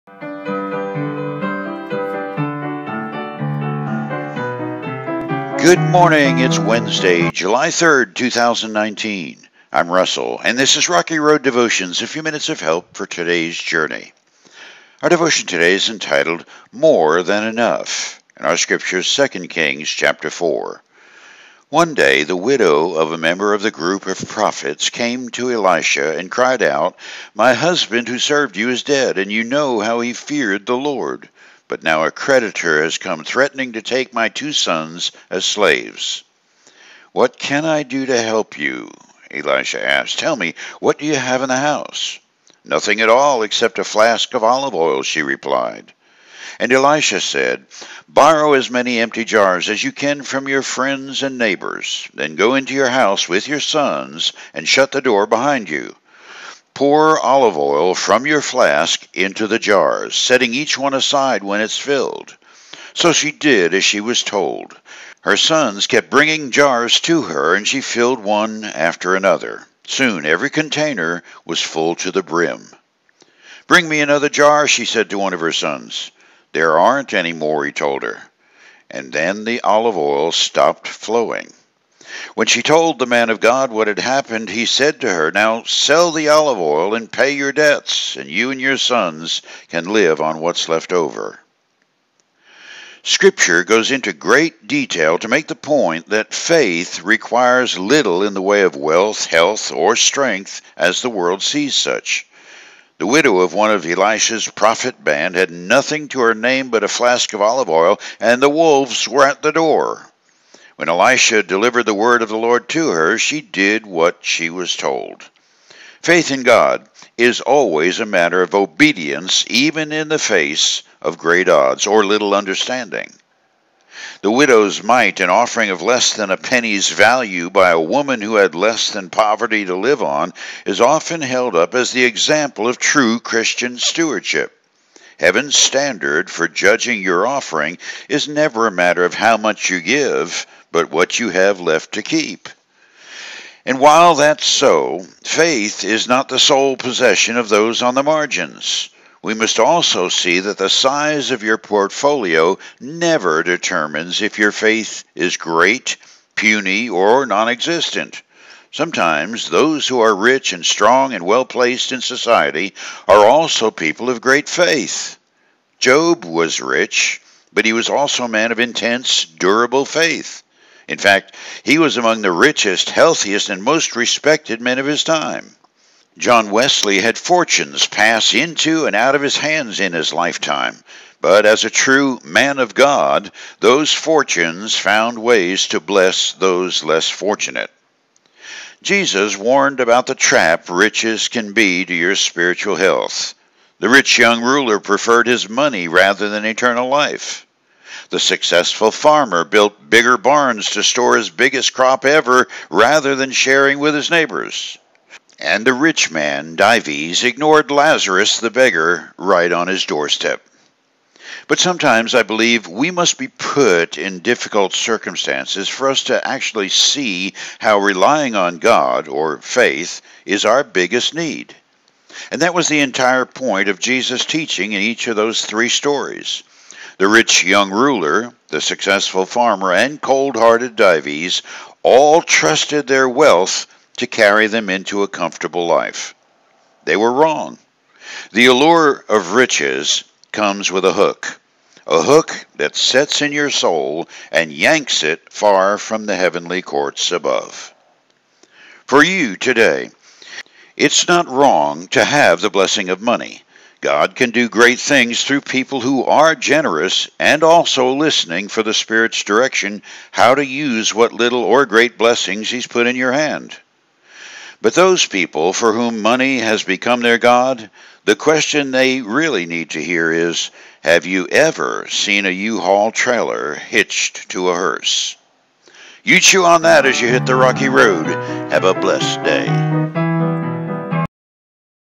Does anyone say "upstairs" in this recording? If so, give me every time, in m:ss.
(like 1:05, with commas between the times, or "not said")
not said.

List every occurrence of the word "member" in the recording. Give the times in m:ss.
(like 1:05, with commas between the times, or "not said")
0:23.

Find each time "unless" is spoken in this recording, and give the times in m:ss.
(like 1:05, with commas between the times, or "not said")
not said.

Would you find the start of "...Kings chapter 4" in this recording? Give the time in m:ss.
0:19.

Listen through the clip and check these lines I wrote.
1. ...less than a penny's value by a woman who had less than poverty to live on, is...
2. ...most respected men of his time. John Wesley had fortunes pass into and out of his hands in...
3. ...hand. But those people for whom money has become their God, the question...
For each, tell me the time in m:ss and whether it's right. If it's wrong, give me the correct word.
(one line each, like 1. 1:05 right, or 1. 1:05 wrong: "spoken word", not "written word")
1. 2:05 right
2. 2:53 right
3. 4:23 right.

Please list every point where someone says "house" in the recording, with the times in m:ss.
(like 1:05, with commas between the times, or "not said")
0:41, 0:52.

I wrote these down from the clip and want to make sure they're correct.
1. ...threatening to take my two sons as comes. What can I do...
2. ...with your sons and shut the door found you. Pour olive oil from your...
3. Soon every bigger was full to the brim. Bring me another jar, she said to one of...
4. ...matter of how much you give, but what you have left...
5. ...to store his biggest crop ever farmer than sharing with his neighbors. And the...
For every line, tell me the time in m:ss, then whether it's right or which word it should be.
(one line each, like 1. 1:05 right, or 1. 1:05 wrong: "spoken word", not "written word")
1. 0:33 wrong: "slaves", not "comes"
2. 0:53 wrong: "behind", not "found"
3. 1:09 wrong: "container", not "bigger"
4. 2:18 right
5. 3:20 wrong: "rather", not "farmer".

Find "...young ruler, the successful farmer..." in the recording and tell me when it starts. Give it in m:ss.
3:47.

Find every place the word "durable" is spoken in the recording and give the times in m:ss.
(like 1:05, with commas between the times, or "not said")
2:49.